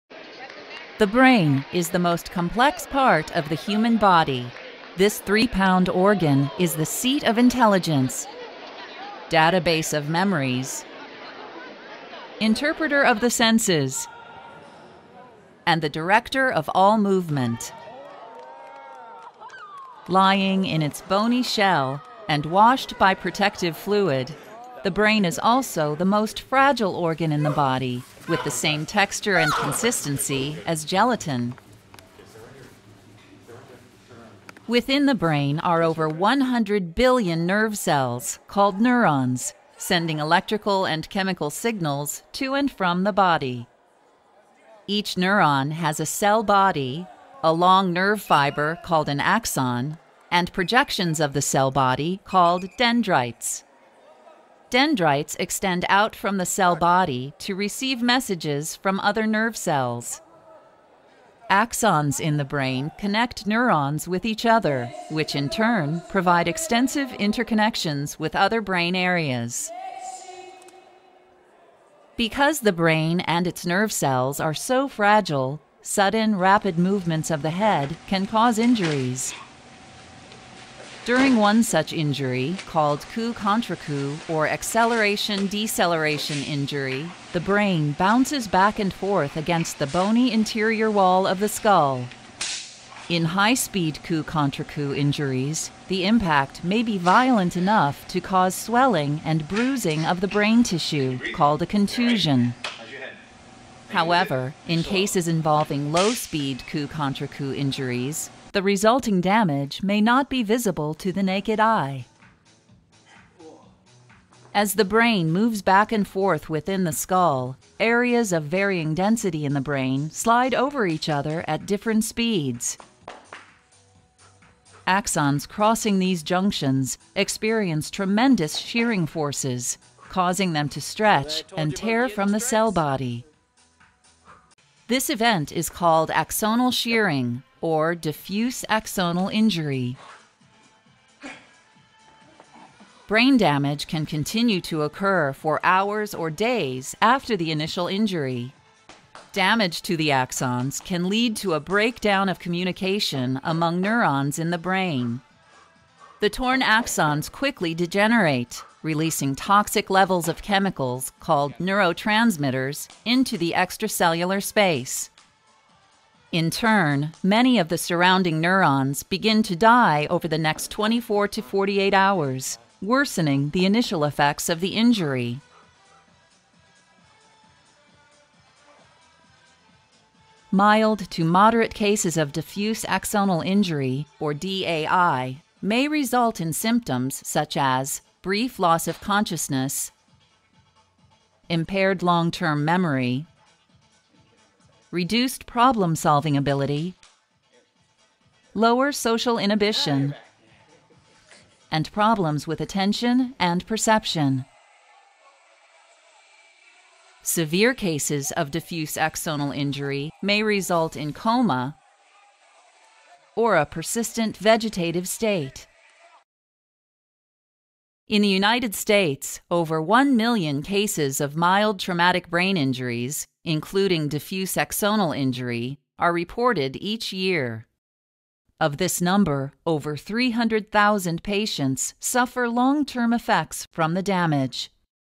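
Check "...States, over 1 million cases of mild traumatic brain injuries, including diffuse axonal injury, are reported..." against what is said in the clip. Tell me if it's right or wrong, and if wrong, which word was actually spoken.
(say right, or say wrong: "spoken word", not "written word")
right.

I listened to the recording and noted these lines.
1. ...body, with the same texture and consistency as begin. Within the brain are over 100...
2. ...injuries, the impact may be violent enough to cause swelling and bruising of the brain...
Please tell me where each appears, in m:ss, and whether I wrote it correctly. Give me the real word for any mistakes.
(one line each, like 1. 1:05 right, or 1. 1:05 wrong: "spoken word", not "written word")
1. 0:27 wrong: "gelatin", not "begin"
2. 1:34 right.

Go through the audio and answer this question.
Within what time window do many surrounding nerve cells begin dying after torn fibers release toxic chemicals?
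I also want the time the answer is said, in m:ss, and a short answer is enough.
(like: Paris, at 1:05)
24 to 48 hours, at 2:50.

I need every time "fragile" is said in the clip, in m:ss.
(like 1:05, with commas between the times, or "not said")
0:26, 1:14.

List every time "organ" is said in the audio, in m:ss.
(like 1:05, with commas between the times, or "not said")
0:05, 0:26.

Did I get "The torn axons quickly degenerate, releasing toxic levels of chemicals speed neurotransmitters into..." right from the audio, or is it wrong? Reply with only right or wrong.
wrong.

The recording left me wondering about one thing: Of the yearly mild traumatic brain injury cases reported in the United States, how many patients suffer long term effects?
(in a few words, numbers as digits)
over 300,000.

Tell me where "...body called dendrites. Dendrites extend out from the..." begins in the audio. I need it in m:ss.
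0:51.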